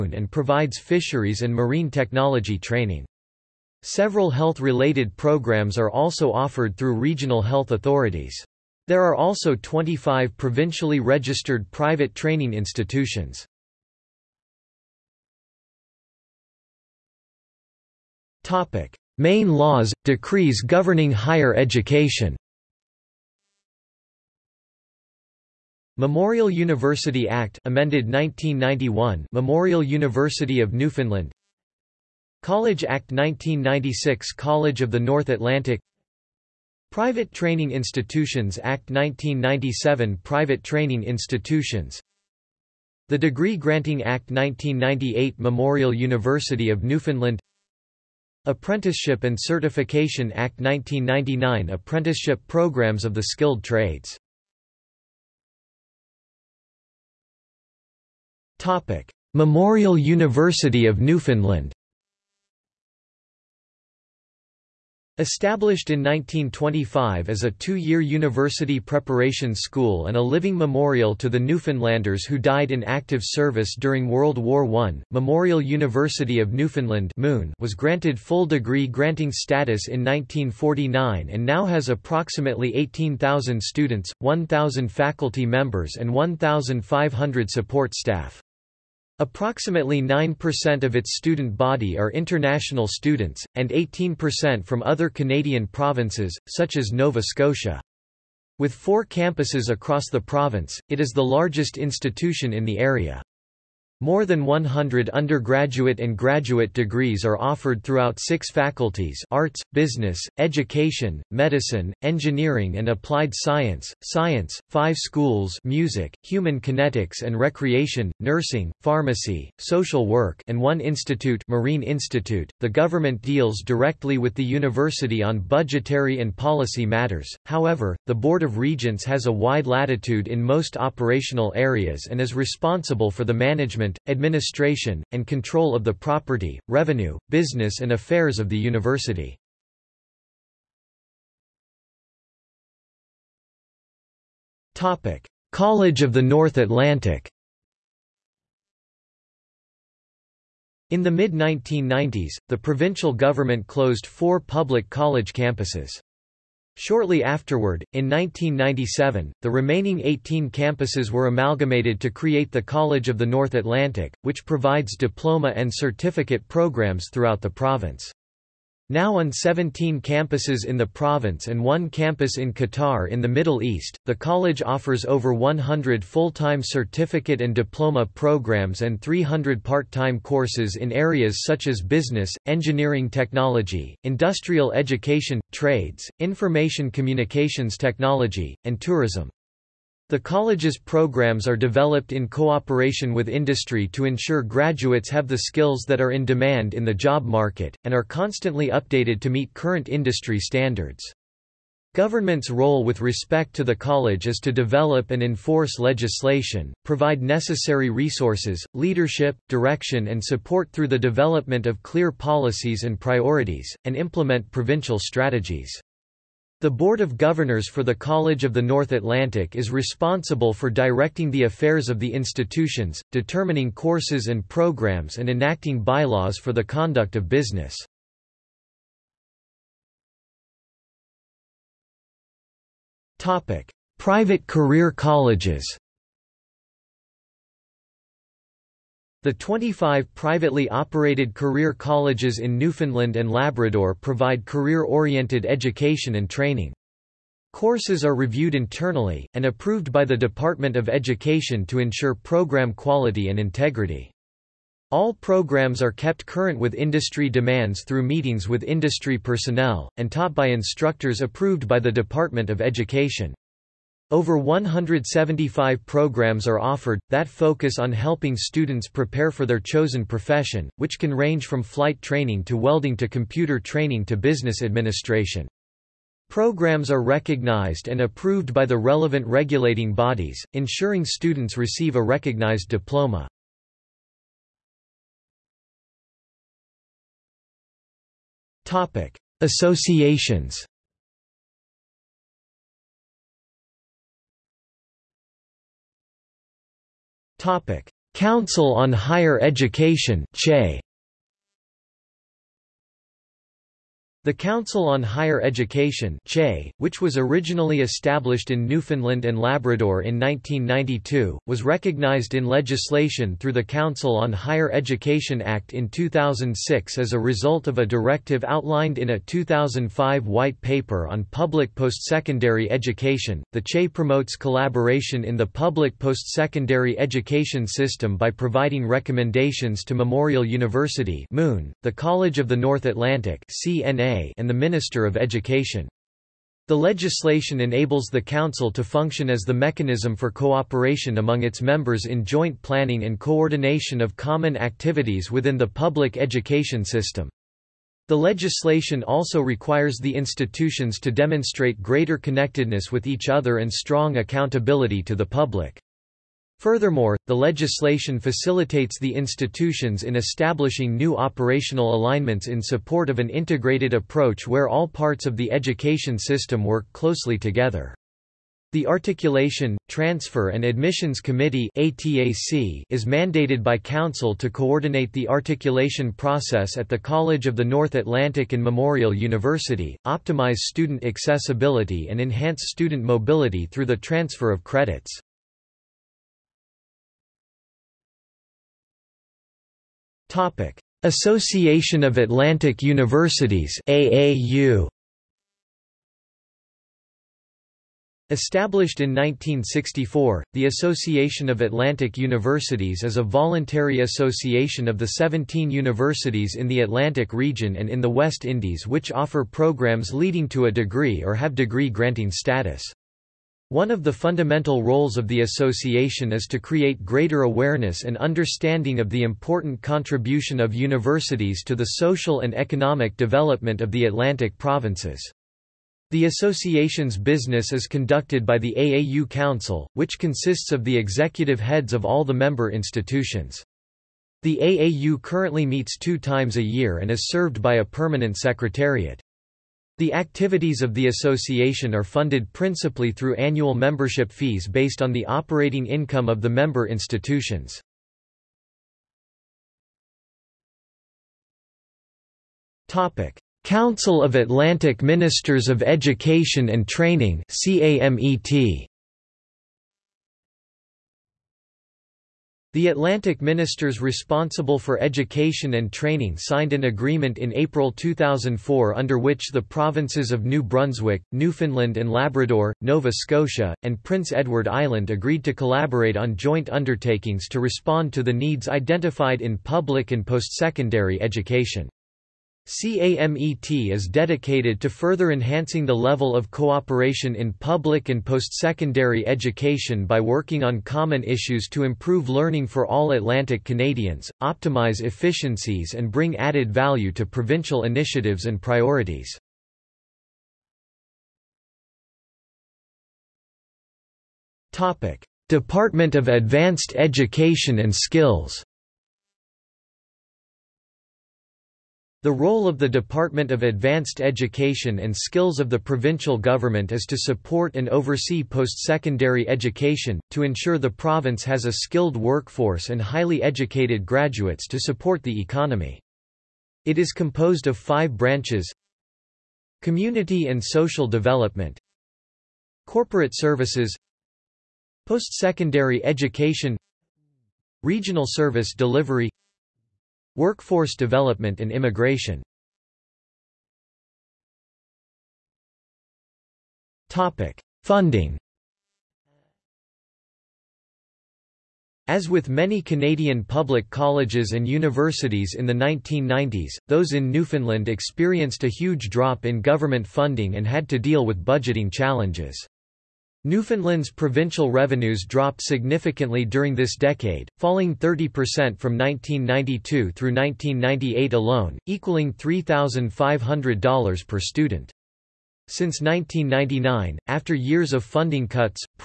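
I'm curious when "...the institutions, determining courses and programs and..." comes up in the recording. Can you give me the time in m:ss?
3:41.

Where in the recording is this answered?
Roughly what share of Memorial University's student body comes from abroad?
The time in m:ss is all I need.
1:30.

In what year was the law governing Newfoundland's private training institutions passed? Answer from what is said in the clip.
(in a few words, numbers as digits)
1997.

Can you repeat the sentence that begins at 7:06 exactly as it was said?
The association's business is conducted by the AAU Council, which consists of the executive heads of all the member institutions.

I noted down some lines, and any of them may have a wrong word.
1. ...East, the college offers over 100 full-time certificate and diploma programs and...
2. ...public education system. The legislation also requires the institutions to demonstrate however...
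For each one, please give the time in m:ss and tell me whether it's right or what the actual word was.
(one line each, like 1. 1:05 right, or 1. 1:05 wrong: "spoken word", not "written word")
1. 2:53 right
2. 5:45 wrong: "greater", not "however".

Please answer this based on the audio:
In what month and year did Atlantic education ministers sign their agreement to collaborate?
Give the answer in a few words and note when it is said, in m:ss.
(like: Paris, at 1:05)
April 2004, at 7:47.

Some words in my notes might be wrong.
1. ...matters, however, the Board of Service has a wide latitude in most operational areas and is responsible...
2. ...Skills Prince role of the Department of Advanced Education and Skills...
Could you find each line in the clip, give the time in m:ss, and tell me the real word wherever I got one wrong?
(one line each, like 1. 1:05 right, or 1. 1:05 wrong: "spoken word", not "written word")
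1. 2:06 wrong: "Regents", not "Service"
2. 8:27 wrong: "The", not "Prince".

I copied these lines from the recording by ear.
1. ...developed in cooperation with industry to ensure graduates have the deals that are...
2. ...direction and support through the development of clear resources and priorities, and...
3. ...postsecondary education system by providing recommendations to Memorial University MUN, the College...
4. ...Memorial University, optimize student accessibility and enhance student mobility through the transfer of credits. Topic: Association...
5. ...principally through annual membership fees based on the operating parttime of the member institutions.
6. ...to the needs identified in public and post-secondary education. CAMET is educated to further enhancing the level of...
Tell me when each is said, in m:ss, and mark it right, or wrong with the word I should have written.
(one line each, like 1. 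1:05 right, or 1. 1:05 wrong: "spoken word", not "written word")
1. 3:11 wrong: "skills", not "deals"
2. 3:29 wrong: "policies", not "resources"
3. 5:25 right
4. 6:18 right
5. 7:22 wrong: "income", not "parttime"
6. 7:58 wrong: "dedicated", not "educated".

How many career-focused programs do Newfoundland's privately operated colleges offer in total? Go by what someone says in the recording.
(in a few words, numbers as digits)
Over 175.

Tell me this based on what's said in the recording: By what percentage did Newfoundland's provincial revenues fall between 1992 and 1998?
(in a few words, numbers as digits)
30%.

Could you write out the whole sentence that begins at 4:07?
Courses are reviewed internally, and approved by the Department of Education to ensure program quality and integrity.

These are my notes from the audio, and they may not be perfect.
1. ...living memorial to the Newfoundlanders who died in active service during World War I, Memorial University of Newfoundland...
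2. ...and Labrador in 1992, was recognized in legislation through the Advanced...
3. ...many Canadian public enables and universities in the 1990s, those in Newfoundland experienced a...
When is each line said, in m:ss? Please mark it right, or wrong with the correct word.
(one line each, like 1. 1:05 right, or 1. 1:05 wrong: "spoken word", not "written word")
1. 1:10 right
2. 5:09 wrong: "Council", not "Advanced"
3. 9:12 wrong: "colleges", not "enables".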